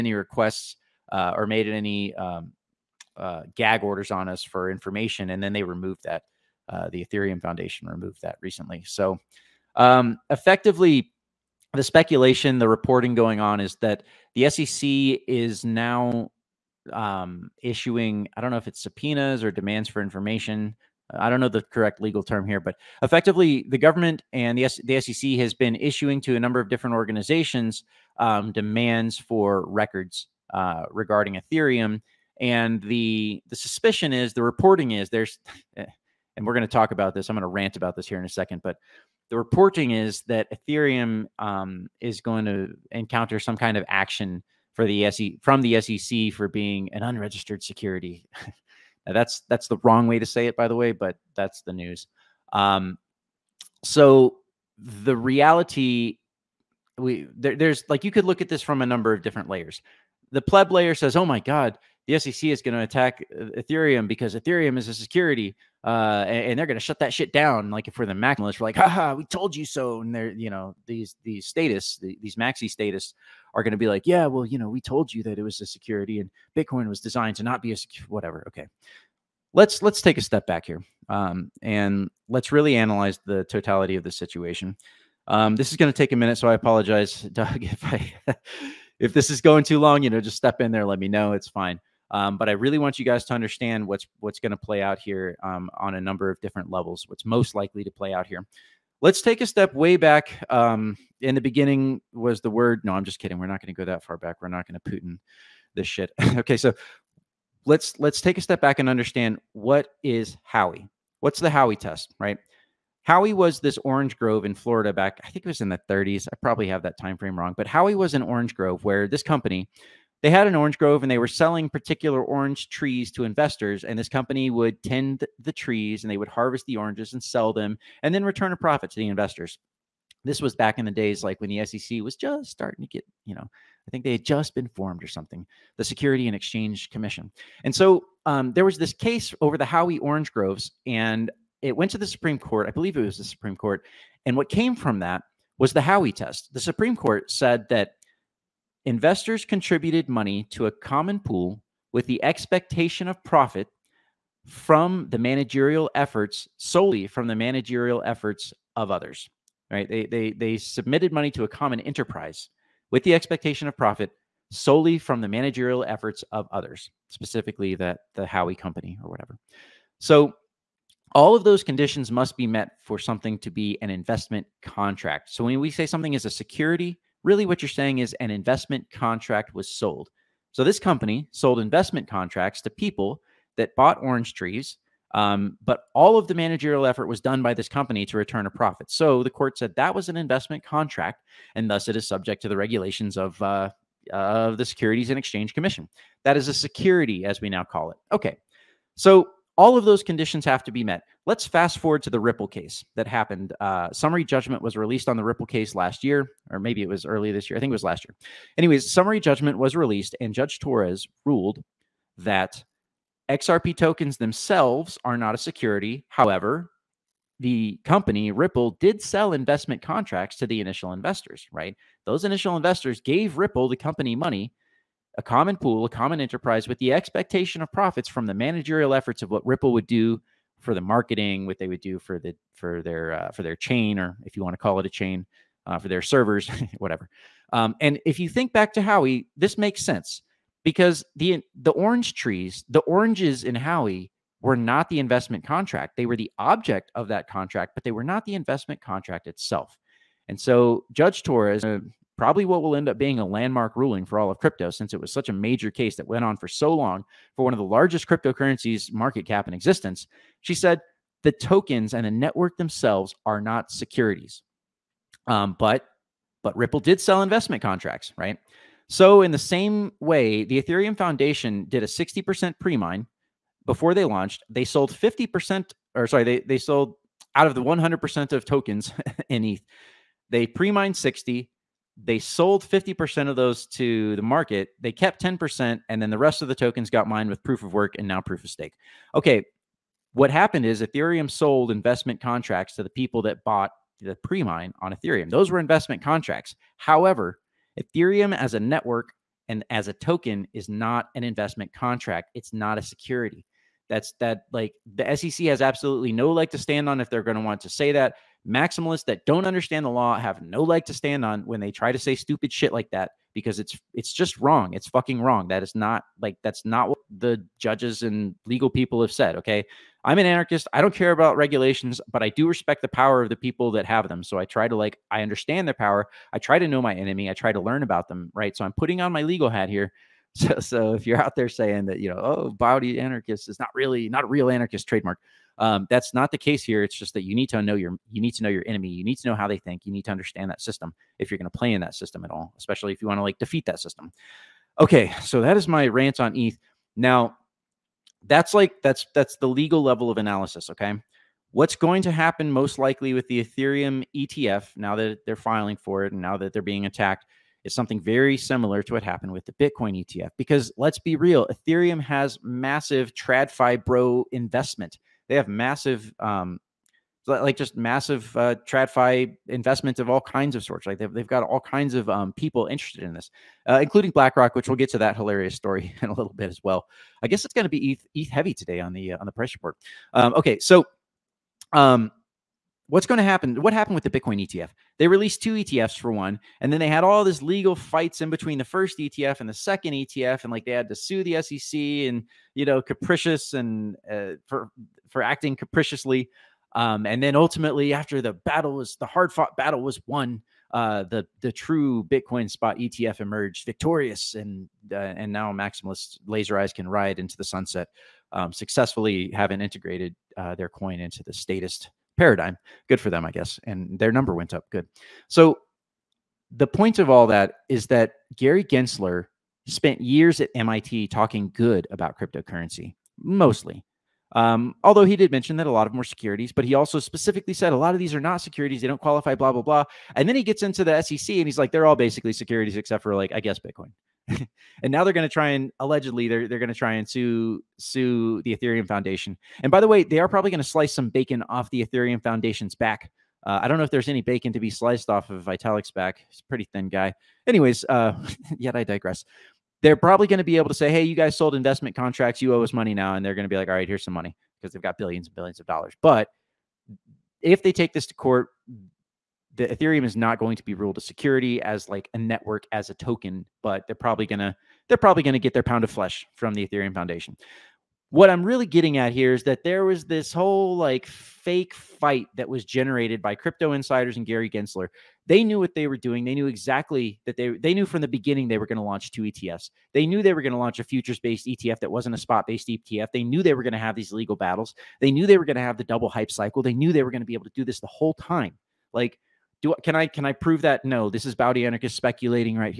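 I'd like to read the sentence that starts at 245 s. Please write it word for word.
They were the object of that contract, but they were not the investment contract itself.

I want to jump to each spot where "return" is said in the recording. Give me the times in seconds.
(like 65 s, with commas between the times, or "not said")
128 s, 188 s.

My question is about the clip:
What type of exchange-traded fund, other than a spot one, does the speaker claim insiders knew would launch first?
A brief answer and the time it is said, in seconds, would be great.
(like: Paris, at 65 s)
Futures-based ETF, at 480 s.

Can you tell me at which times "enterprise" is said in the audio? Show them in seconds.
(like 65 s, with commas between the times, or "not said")
161 s, 226 s.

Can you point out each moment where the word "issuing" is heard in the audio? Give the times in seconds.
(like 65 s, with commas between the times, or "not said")
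17 s, 25 s.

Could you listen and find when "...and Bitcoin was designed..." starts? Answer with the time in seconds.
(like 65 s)
76 s.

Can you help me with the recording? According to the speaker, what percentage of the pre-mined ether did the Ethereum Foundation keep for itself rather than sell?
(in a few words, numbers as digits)
10%.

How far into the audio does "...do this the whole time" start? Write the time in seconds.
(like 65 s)
487 s.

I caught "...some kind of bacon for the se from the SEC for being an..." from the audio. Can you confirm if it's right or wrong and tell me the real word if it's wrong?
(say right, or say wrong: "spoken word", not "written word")
wrong: "action", not "bacon".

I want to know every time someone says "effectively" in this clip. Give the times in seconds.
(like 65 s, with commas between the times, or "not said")
10 s, 23 s.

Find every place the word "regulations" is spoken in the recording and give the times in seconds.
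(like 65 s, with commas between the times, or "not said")
192 s, 321 s.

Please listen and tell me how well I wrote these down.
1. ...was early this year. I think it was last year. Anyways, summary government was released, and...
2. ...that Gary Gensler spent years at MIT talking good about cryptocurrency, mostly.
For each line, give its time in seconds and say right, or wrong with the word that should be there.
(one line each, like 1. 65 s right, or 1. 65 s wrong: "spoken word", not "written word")
1. 206 s wrong: "judgment", not "government"
2. 417 s right.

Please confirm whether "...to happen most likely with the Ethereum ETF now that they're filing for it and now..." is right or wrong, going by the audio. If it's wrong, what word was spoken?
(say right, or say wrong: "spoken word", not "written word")
right.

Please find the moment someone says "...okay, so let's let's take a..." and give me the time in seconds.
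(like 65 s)
106 s.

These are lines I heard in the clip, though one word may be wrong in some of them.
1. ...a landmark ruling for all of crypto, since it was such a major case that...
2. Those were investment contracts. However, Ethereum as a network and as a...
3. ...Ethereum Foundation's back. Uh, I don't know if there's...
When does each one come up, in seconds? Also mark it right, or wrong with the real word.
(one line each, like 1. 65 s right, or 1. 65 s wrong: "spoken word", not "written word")
1. 253 s right
2. 295 s right
3. 441 s right.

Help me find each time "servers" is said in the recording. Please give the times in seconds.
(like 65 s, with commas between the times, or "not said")
236 s.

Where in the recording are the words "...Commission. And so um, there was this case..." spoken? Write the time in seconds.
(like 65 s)
136 s.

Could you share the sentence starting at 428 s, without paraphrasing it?
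They don't qualify, blah, blah, blah.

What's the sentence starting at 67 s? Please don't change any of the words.
Like if we're the maximalists, we're like, haha, we told you so.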